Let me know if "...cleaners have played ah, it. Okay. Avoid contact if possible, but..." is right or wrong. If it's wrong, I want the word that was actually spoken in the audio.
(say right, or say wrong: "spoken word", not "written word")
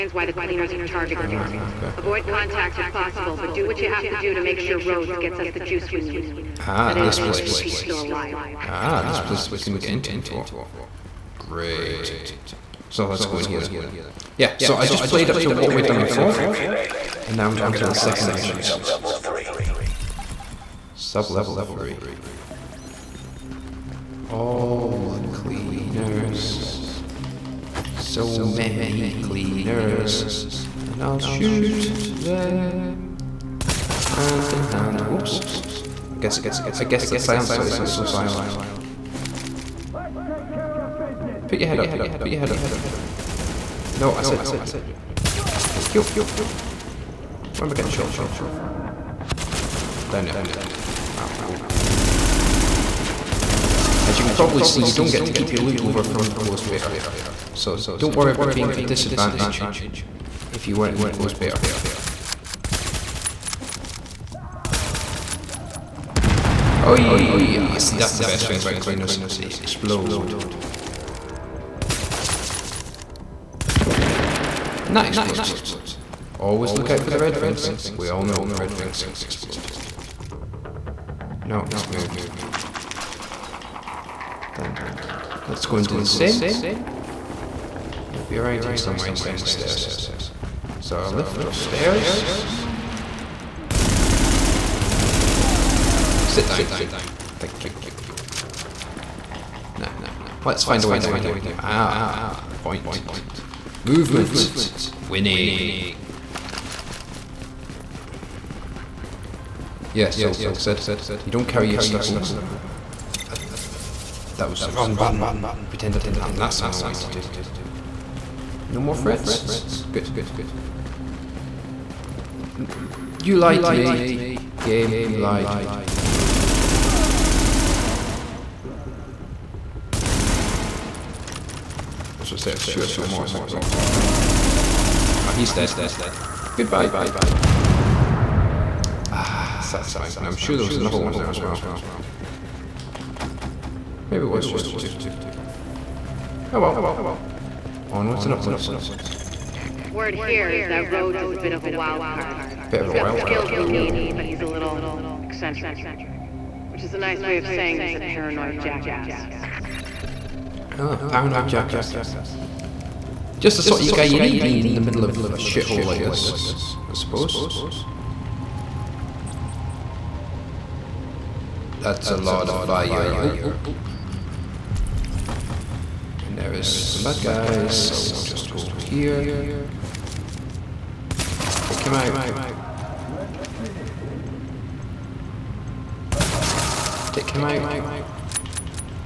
wrong: "targeted", not "played".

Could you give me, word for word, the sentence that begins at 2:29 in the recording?
Word here is that Rhodes is a bit of a wild card.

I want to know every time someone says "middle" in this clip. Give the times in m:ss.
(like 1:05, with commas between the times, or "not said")
2:44.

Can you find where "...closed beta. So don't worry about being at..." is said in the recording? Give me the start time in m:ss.
0:56.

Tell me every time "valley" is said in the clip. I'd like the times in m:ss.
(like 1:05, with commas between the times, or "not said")
not said.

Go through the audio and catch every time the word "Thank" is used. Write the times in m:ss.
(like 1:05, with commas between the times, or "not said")
0:45, 1:37.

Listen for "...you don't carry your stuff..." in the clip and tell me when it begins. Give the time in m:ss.
1:51.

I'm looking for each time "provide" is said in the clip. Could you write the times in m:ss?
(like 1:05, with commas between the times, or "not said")
not said.